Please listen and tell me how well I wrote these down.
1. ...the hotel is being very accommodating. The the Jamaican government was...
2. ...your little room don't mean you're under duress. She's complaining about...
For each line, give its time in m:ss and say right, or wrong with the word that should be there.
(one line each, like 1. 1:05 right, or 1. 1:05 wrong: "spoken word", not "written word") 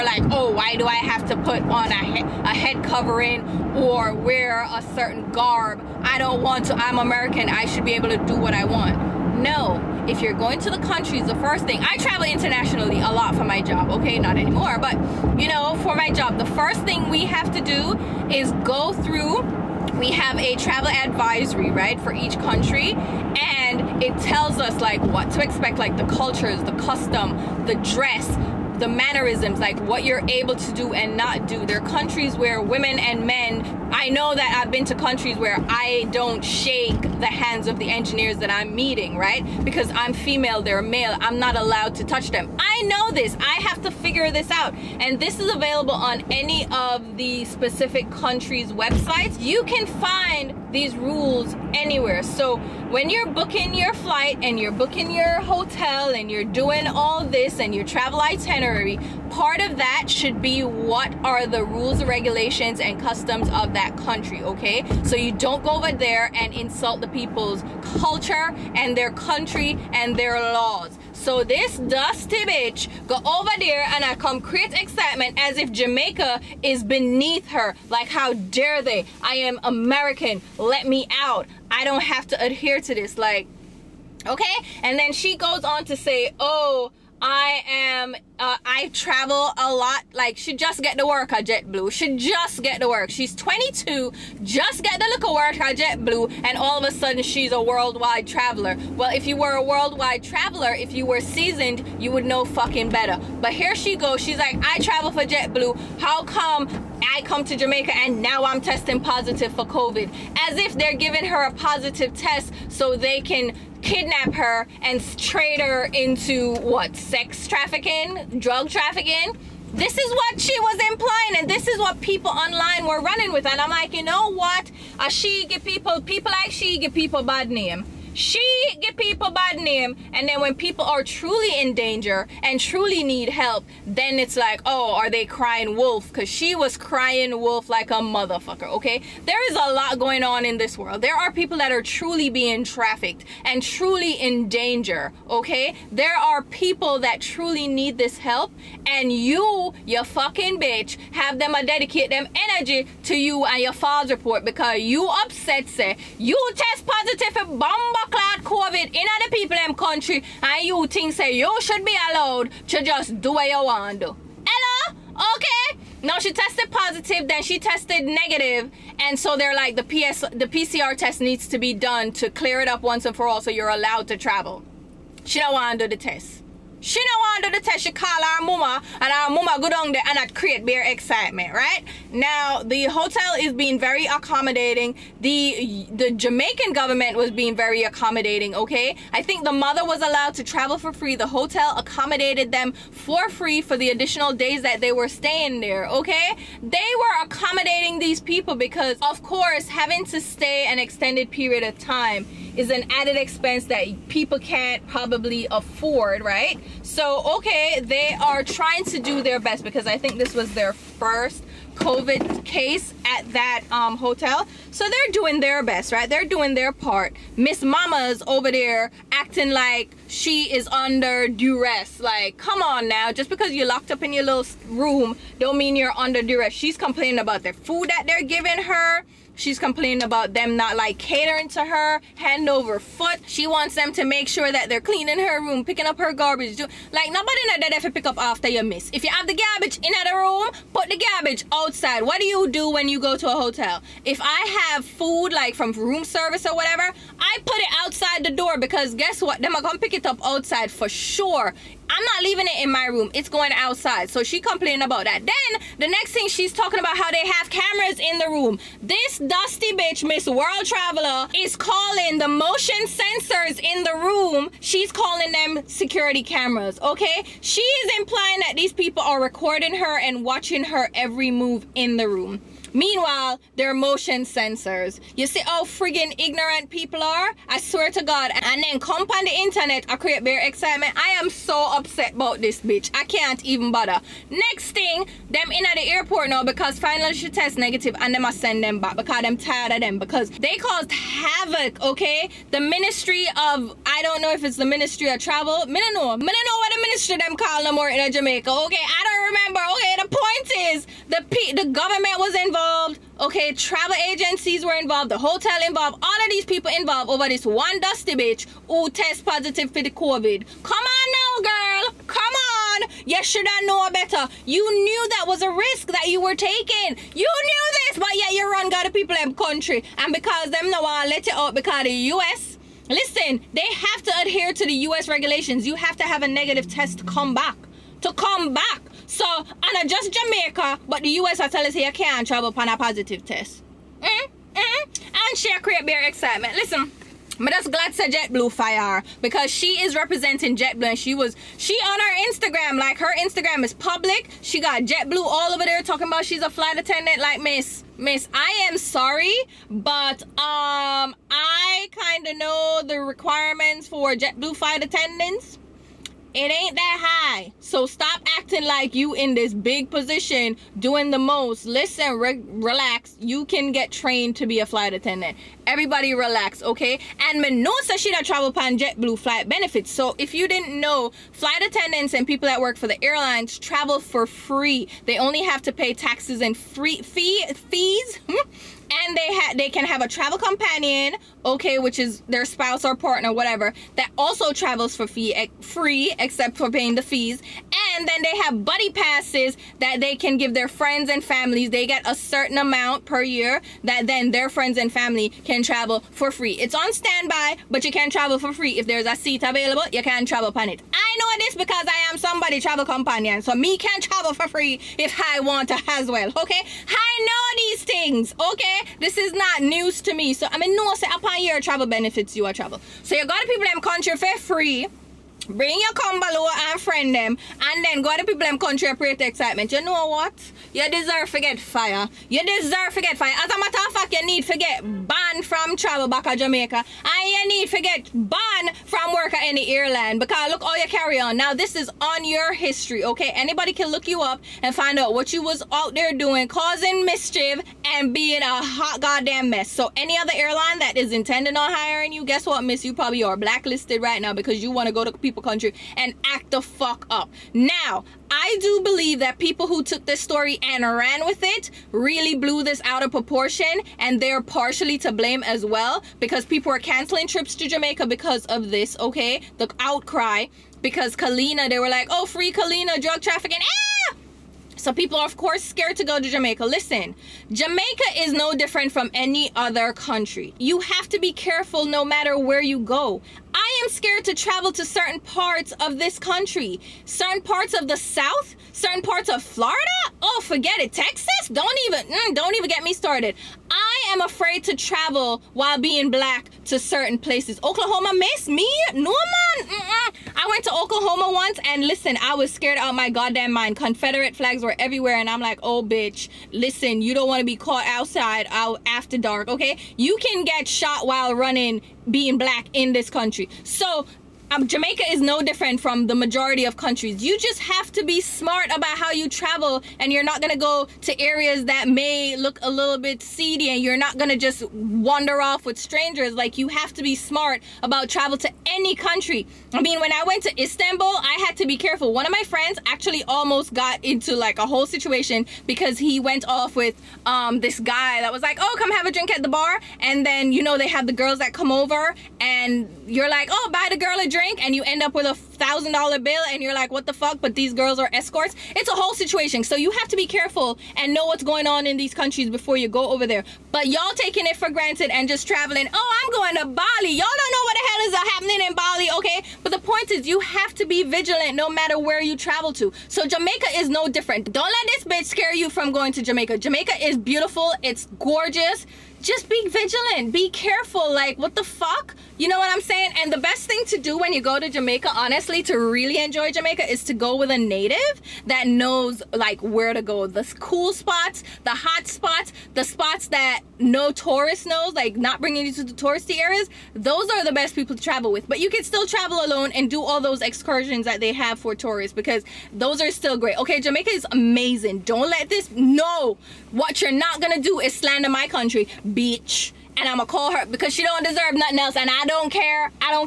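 1. 3:02 right
2. 3:44 right.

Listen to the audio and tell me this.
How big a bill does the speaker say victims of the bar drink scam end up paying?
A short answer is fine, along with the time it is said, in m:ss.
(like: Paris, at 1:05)
$1,000, at 8:55.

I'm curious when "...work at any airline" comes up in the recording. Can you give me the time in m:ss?
7:09.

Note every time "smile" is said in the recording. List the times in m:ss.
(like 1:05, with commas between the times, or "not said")
not said.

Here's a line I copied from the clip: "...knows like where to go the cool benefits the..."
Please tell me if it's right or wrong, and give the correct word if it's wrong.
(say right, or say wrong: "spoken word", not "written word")
wrong: "spots", not "benefits".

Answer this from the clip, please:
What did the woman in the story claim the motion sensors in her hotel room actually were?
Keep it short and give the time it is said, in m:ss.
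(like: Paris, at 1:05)
security cameras, at 4:25.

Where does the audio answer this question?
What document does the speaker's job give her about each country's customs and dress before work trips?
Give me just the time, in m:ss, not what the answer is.
0:20.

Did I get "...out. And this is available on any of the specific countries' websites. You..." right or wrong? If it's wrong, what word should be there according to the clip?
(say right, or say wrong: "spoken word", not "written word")
right.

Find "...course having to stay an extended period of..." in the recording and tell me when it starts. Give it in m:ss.
3:19.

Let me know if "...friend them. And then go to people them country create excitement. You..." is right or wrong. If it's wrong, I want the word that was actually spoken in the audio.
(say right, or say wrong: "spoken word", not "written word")
right.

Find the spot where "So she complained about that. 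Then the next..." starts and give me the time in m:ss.
4:14.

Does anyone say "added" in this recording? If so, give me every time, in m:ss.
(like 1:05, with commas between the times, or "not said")
3:22.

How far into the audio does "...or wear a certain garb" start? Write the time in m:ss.
0:03.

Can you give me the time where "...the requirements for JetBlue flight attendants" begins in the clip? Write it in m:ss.
5:52.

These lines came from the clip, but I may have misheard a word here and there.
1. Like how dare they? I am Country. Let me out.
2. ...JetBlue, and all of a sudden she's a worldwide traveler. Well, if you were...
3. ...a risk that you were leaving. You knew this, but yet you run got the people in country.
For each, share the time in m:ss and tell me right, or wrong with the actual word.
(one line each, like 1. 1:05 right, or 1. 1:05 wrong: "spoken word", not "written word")
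1. 1:17 wrong: "American", not "Country"
2. 1:35 right
3. 5:15 wrong: "taking", not "leaving".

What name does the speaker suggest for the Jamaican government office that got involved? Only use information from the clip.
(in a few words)
Ministry of Travel.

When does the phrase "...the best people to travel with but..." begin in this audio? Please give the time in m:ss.
9:37.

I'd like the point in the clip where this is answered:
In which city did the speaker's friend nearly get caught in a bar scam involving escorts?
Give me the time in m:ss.
8:40.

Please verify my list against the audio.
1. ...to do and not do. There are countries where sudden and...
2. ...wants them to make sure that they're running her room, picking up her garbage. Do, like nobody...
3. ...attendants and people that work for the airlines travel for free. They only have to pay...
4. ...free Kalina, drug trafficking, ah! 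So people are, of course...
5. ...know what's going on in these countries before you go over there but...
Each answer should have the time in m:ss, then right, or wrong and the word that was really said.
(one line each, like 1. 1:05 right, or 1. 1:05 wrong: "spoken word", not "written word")
1. 0:30 wrong: "women", not "sudden"
2. 3:53 wrong: "cleaning", not "running"
3. 6:11 right
4. 7:42 right
5. 9:01 right.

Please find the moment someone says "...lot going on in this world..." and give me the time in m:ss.
2:19.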